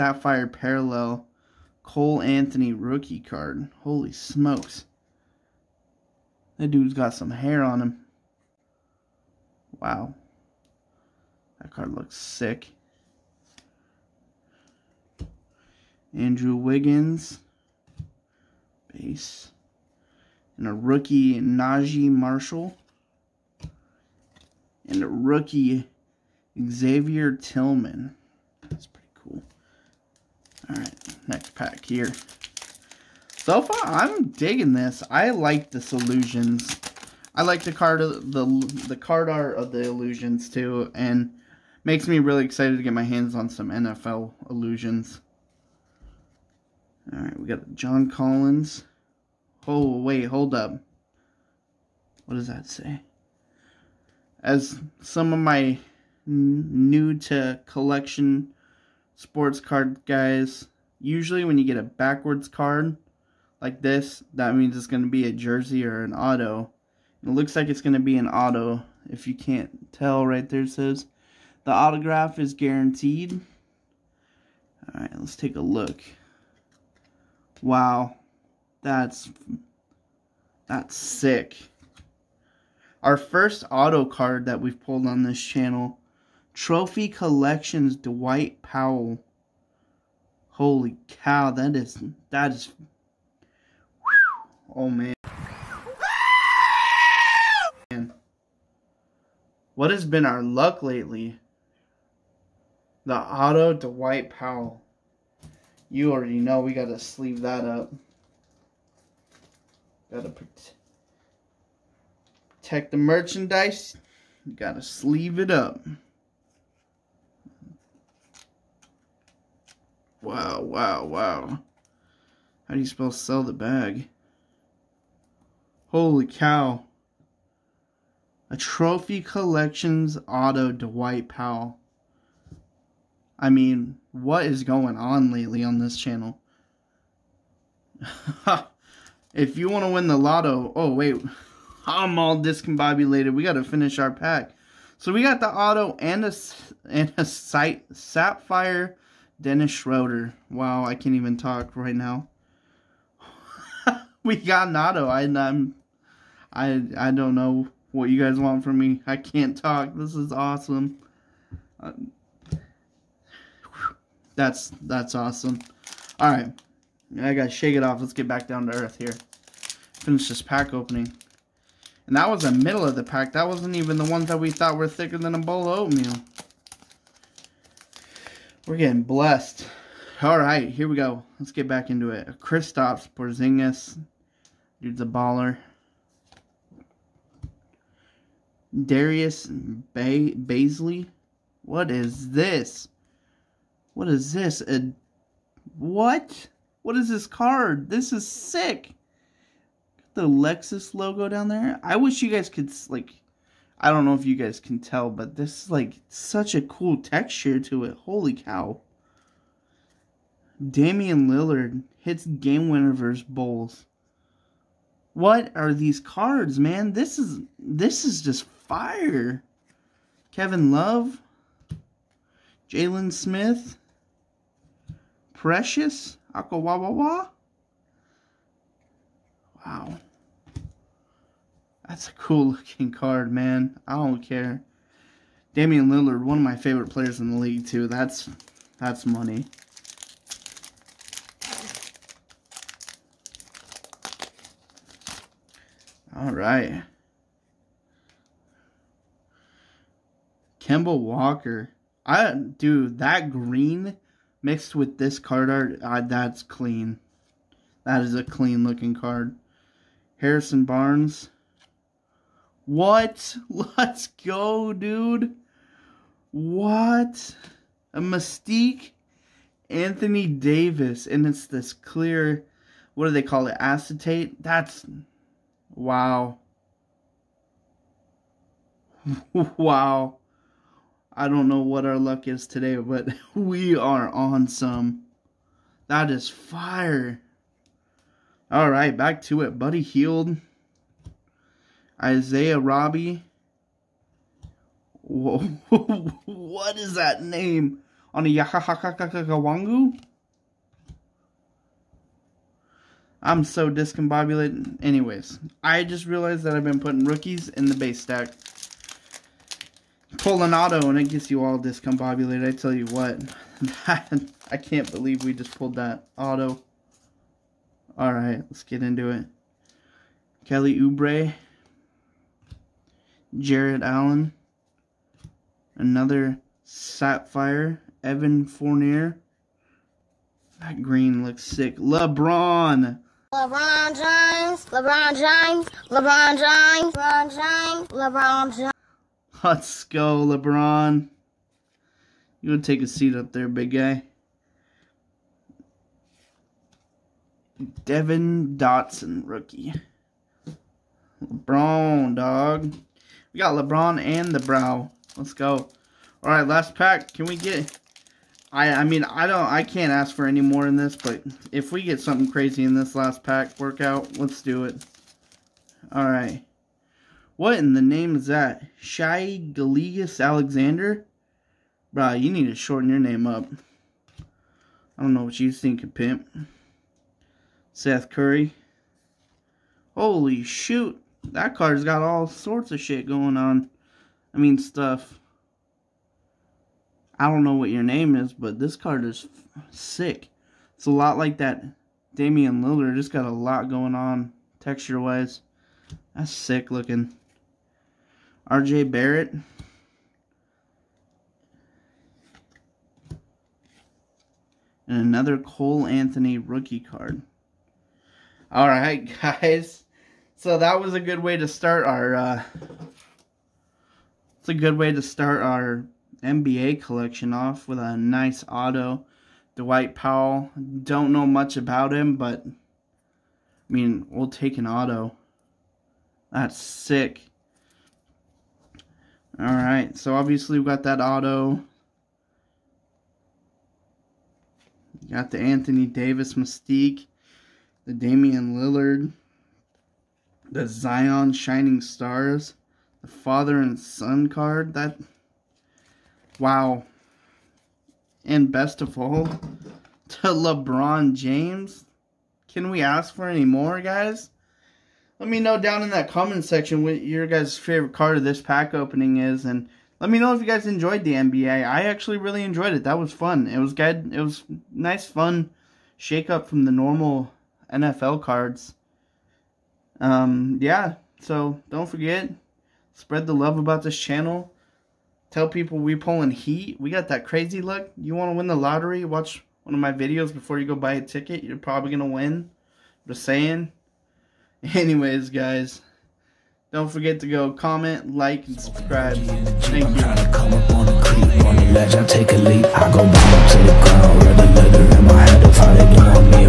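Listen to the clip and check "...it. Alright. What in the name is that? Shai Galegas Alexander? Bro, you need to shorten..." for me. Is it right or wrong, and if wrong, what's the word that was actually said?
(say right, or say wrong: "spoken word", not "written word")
right.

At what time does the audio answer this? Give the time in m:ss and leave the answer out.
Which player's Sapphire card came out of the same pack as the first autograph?
2:29.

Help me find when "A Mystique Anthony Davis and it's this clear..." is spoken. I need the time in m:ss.
4:27.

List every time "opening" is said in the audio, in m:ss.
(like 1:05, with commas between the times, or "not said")
2:50, 7:38.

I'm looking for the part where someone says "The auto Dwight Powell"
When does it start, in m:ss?
1:43.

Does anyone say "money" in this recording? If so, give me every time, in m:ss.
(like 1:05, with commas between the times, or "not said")
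3:59.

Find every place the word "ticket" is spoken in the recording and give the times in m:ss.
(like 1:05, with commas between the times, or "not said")
8:01.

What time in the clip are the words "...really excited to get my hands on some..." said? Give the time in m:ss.
0:42.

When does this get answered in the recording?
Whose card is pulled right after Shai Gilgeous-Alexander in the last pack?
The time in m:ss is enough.
6:17.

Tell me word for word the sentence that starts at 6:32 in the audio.
Just got a lot going on texture-wise.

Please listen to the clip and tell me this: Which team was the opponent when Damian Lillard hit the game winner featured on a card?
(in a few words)
Bulls.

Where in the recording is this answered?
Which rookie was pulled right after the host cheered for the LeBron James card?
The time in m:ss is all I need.
5:47.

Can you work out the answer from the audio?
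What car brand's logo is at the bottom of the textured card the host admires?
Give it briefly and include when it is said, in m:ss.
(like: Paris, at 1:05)
Lexus, at 3:20.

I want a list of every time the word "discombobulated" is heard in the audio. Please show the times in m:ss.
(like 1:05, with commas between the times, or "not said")
2:22, 5:03, 5:11.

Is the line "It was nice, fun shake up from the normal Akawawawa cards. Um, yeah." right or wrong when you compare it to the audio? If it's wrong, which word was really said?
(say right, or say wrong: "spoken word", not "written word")
wrong: "NFL", not "Akawawawa".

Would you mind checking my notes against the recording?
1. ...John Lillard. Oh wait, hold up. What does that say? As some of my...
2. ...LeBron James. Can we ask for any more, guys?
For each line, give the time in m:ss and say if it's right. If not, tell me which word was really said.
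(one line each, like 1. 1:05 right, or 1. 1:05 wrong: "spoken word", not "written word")
1. 0:47 wrong: "Collins", not "Lillard"
2. 7:30 right.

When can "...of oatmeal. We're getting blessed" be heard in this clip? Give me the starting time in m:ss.
2:55.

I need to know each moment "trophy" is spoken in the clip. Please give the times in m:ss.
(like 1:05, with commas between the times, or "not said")
1:26, 2:08.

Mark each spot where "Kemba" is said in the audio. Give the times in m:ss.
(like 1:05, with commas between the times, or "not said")
4:10.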